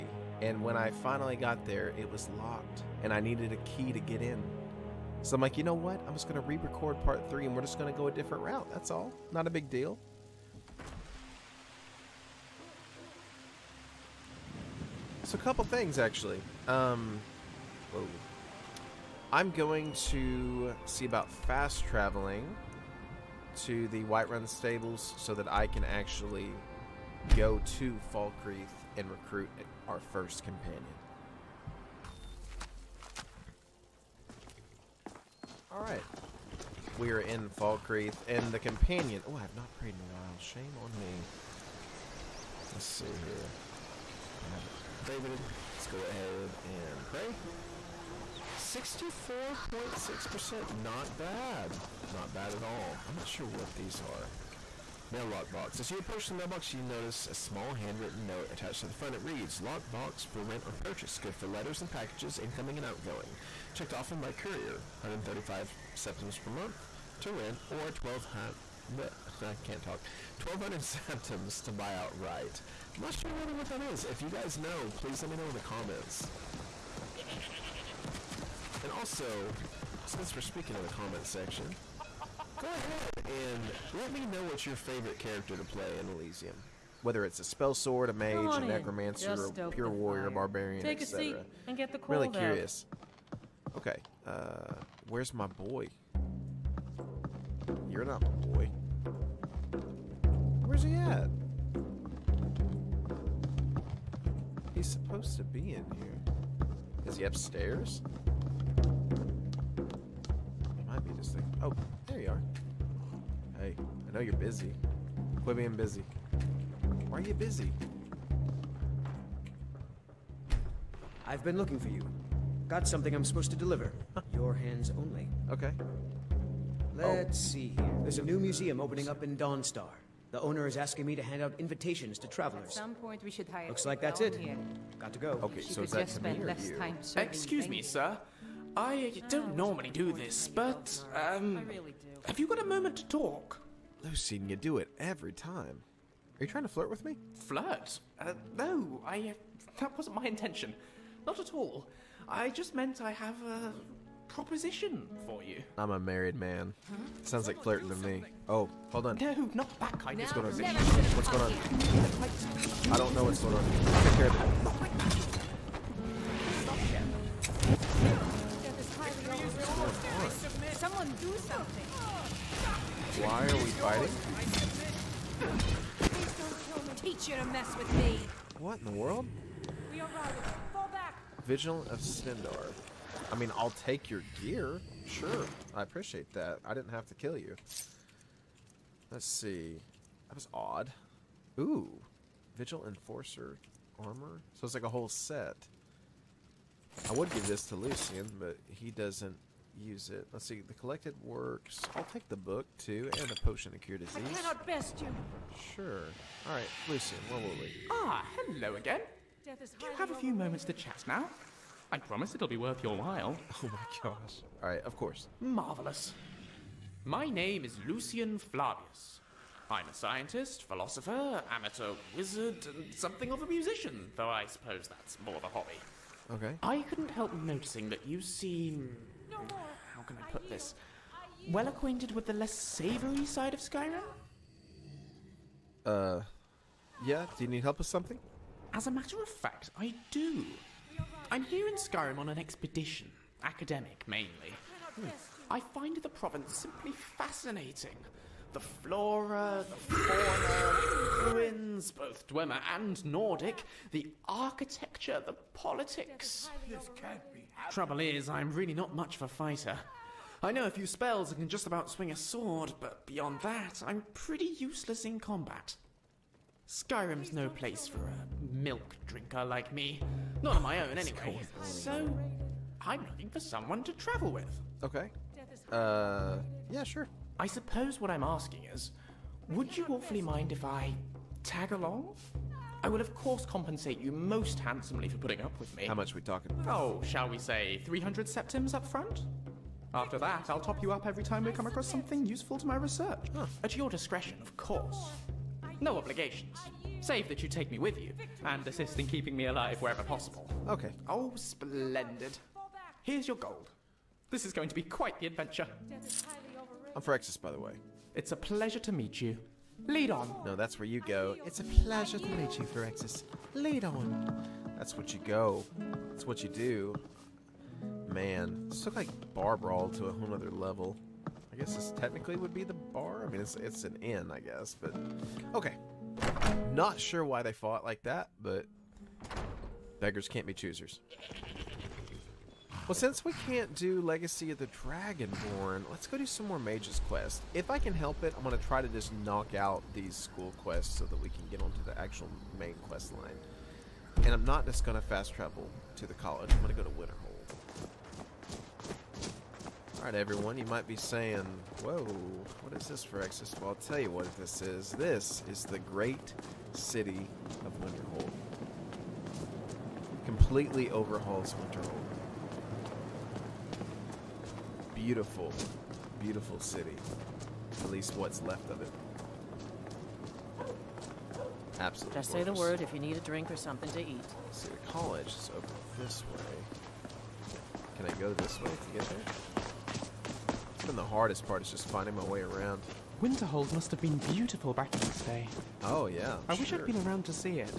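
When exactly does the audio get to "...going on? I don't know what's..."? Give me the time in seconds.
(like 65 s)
161 s.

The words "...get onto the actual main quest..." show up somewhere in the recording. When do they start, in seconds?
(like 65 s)
341 s.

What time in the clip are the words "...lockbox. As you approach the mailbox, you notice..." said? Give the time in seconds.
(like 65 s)
55 s.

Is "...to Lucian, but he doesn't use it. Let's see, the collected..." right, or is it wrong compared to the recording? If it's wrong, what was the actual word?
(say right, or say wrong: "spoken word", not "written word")
right.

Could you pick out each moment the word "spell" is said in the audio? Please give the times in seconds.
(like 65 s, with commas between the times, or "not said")
87 s, 260 s.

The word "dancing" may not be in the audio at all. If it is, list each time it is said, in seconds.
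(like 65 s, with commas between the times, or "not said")
not said.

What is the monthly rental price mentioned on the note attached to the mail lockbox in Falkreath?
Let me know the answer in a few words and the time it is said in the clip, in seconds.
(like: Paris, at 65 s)
135 septims, at 65 s.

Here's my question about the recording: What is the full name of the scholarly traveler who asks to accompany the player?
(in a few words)
Lucian Flavius.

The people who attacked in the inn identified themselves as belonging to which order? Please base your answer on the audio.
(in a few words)
Vigilant of Stendarr.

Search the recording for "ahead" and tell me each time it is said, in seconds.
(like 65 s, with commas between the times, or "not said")
46 s, 82 s.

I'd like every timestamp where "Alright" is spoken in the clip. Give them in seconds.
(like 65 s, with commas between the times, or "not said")
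35 s, 349 s.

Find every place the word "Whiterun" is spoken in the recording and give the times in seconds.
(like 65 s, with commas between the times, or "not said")
24 s.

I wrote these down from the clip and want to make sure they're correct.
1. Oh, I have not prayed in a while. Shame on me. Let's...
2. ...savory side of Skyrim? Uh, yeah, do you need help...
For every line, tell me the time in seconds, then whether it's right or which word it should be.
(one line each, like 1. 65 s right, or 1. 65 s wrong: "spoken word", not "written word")
1. 39 s right
2. 232 s right.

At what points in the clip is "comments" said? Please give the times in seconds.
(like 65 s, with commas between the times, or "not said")
75 s, 80 s.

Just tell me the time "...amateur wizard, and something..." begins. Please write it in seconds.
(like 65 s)
221 s.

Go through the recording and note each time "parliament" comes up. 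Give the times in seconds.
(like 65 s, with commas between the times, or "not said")
not said.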